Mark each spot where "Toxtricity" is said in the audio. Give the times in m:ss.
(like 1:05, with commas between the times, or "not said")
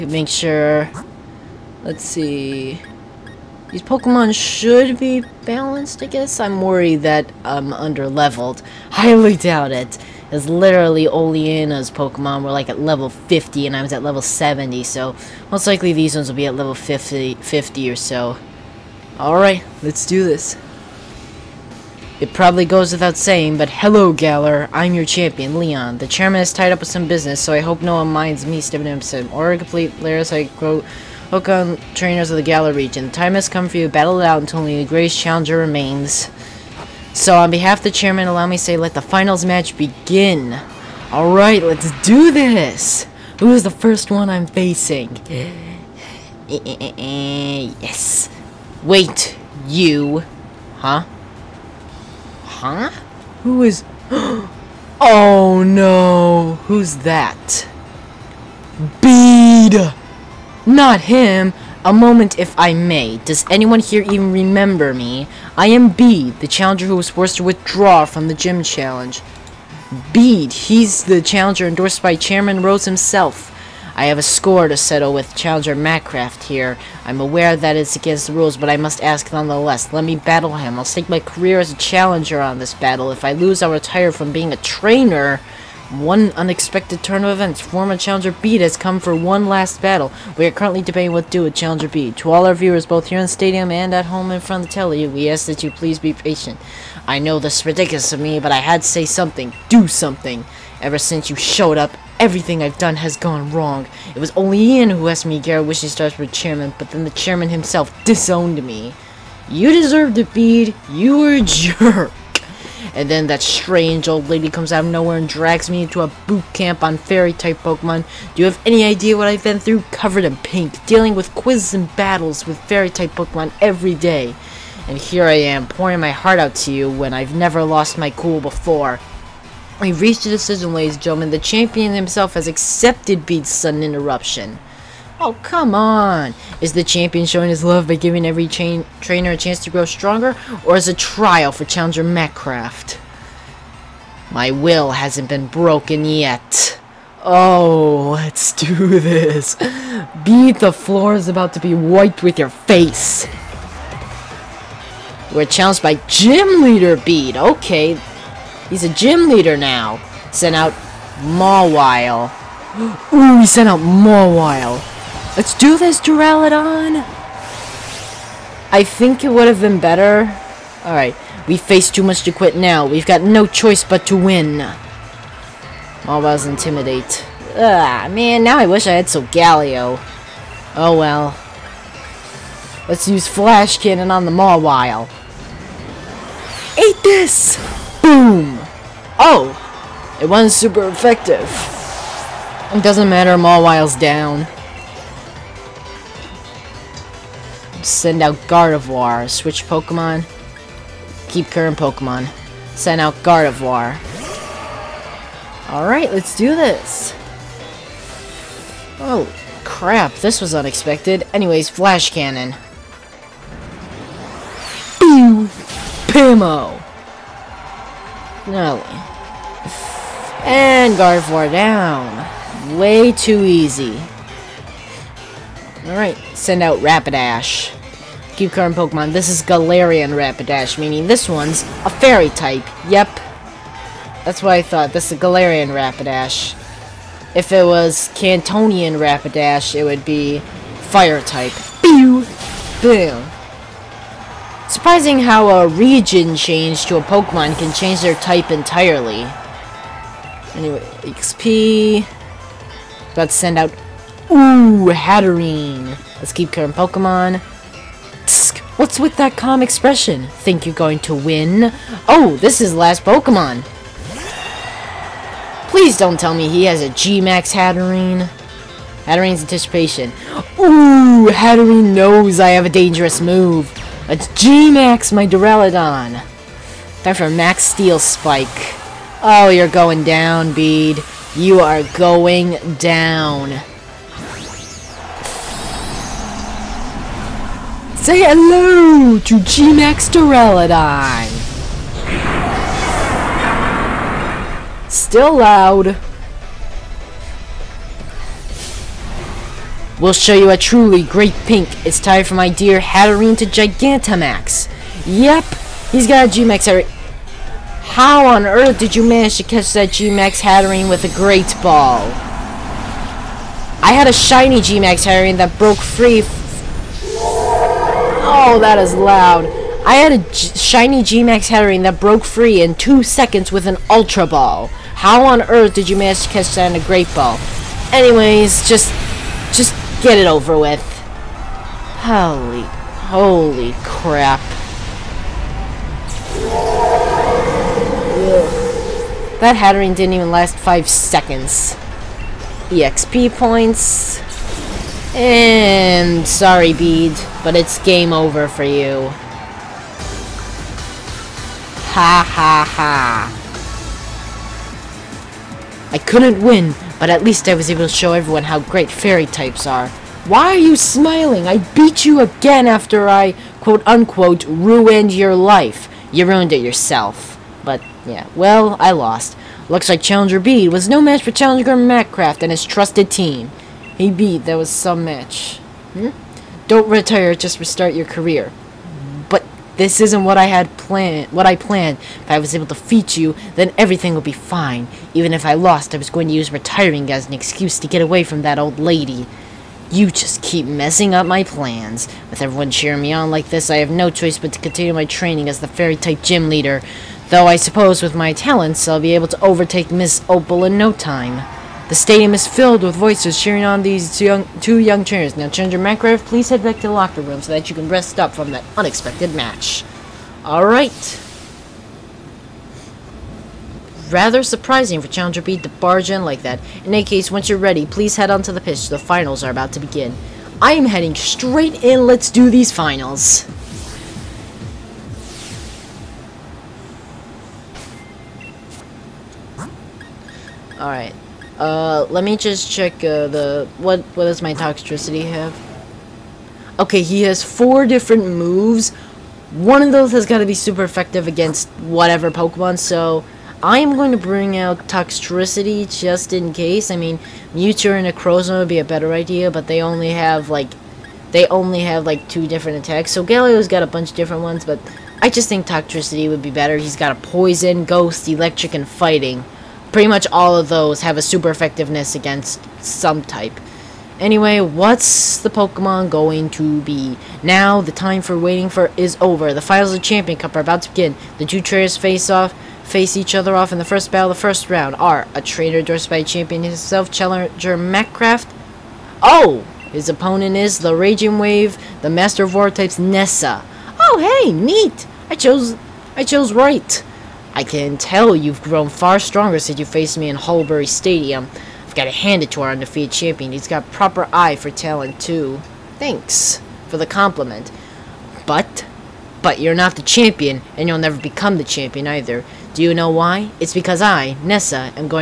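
7:14, 7:24, 7:35.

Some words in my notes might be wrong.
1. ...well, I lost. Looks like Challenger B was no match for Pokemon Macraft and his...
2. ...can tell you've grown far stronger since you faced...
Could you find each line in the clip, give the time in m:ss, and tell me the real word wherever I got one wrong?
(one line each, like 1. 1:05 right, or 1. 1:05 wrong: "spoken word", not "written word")
1. 6:08 wrong: "Challenger", not "Pokemon"
2. 8:07 right.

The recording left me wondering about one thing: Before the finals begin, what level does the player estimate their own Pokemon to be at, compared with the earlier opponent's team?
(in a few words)
70.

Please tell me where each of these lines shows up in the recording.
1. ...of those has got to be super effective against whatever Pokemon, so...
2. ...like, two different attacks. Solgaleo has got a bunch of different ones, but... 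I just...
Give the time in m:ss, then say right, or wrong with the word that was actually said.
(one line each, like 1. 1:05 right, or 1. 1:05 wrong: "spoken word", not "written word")
1. 7:19 right
2. 7:32 right.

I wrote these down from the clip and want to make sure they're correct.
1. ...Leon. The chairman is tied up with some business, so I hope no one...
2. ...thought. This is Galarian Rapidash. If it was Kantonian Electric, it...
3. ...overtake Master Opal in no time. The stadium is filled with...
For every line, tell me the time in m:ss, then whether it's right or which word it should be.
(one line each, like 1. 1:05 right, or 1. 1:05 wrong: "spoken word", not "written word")
1. 0:25 right
2. 3:54 wrong: "Rapidash", not "Electric"
3. 6:39 wrong: "Miss", not "Master".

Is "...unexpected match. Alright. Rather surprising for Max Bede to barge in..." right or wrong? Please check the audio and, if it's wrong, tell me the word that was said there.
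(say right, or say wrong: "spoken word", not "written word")
wrong: "Challenger", not "Max".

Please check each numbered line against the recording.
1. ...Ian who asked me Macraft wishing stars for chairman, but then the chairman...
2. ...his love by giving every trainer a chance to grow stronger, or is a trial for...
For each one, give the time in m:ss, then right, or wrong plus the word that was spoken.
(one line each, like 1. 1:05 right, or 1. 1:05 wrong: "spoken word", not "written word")
1. 1:44 wrong: "Garrett", not "Macraft"
2. 2:17 right.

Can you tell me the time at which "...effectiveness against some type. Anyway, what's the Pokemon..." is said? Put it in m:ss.
7:41.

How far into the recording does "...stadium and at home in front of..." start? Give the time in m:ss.
1:33.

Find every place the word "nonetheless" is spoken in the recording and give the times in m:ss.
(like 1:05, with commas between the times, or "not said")
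1:19.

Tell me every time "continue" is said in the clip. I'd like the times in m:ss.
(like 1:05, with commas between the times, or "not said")
6:34.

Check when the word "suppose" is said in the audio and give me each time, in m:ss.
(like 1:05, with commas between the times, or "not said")
6:37.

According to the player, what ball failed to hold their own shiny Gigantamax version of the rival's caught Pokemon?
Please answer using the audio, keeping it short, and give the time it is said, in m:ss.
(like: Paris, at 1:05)
Ultra Ball, at 5:23.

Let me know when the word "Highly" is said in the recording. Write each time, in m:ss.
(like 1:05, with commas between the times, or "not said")
0:08.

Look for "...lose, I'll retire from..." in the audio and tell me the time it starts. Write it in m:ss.
1:23.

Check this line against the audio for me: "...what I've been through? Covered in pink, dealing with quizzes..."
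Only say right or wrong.
right.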